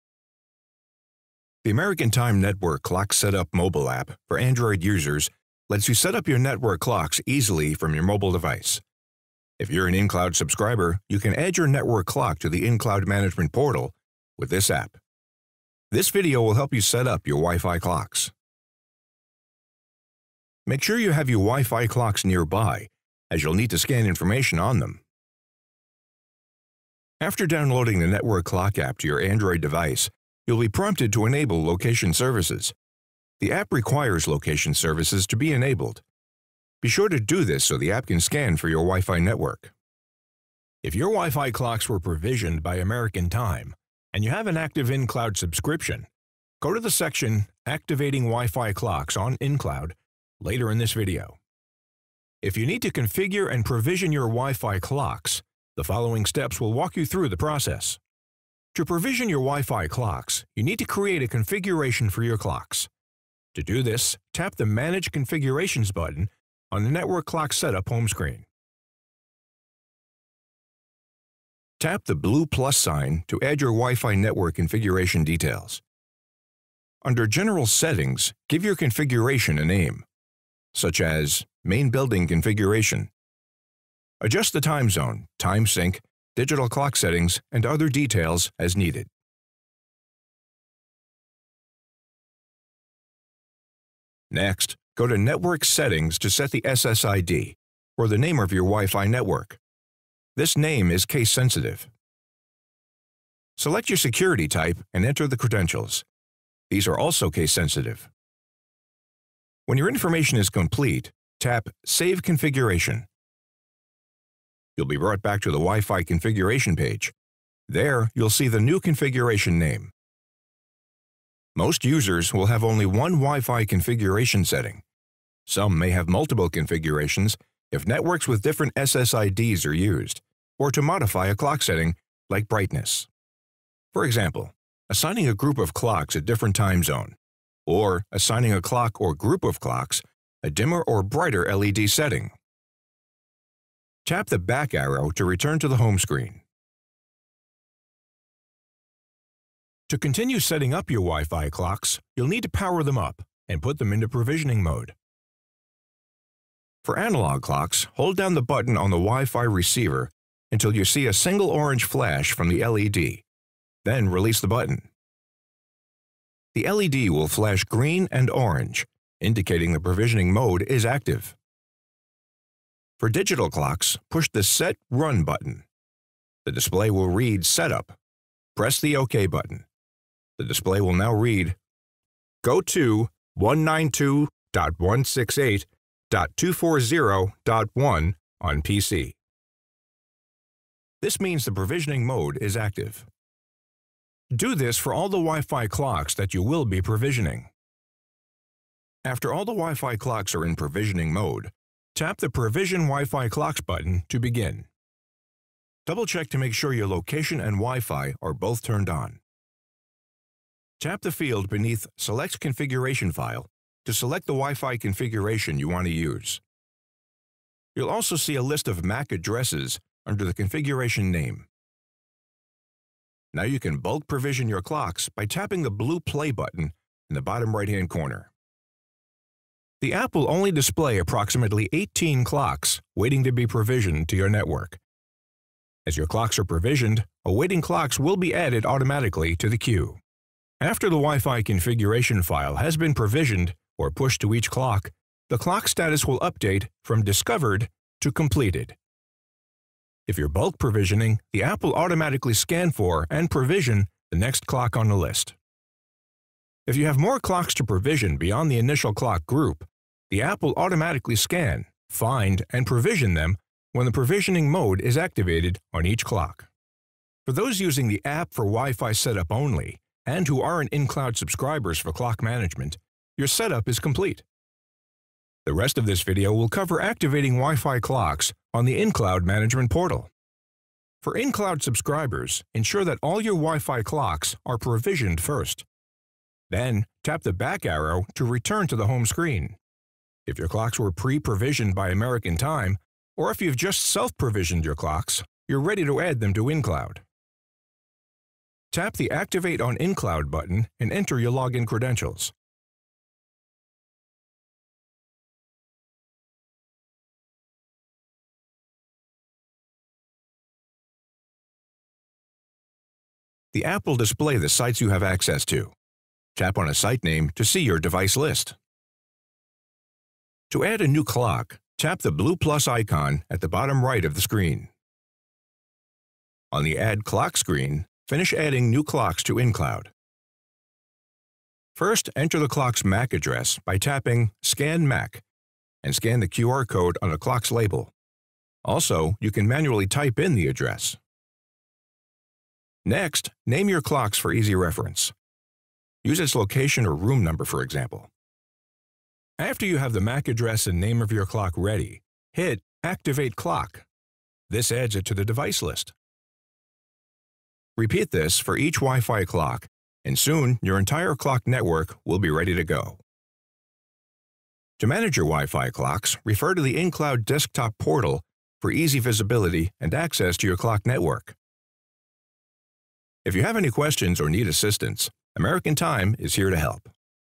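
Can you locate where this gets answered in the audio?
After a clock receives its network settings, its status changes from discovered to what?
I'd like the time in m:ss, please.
4:08.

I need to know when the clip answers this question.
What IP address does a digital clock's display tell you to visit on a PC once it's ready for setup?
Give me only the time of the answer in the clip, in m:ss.
3:03.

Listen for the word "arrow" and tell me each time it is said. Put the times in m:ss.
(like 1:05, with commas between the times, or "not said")
2:24, 4:47.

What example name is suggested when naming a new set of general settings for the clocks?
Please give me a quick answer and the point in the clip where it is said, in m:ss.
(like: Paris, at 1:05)
Main Building Configuration, at 1:21.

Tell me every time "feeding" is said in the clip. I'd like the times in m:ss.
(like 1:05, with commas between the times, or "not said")
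not said.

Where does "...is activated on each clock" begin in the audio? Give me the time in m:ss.
4:24.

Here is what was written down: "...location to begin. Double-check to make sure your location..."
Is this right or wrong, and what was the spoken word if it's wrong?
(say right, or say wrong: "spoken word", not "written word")
wrong: "button", not "location".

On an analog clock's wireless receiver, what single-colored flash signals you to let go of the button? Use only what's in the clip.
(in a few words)
A single orange flash.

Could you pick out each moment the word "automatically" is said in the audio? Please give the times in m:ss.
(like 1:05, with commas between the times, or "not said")
3:58, 4:11, 4:20.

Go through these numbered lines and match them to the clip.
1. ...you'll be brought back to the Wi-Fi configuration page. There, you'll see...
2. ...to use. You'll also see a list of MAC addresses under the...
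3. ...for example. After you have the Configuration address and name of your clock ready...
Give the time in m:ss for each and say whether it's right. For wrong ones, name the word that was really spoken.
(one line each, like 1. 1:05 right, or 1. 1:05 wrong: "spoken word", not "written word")
1. 1:54 right
2. 3:35 right
3. 5:47 wrong: "MAC", not "Configuration".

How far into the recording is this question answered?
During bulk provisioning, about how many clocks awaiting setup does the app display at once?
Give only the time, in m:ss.
3:51.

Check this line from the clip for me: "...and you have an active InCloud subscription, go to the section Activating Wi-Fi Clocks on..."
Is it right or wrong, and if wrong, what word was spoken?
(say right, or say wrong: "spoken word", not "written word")
right.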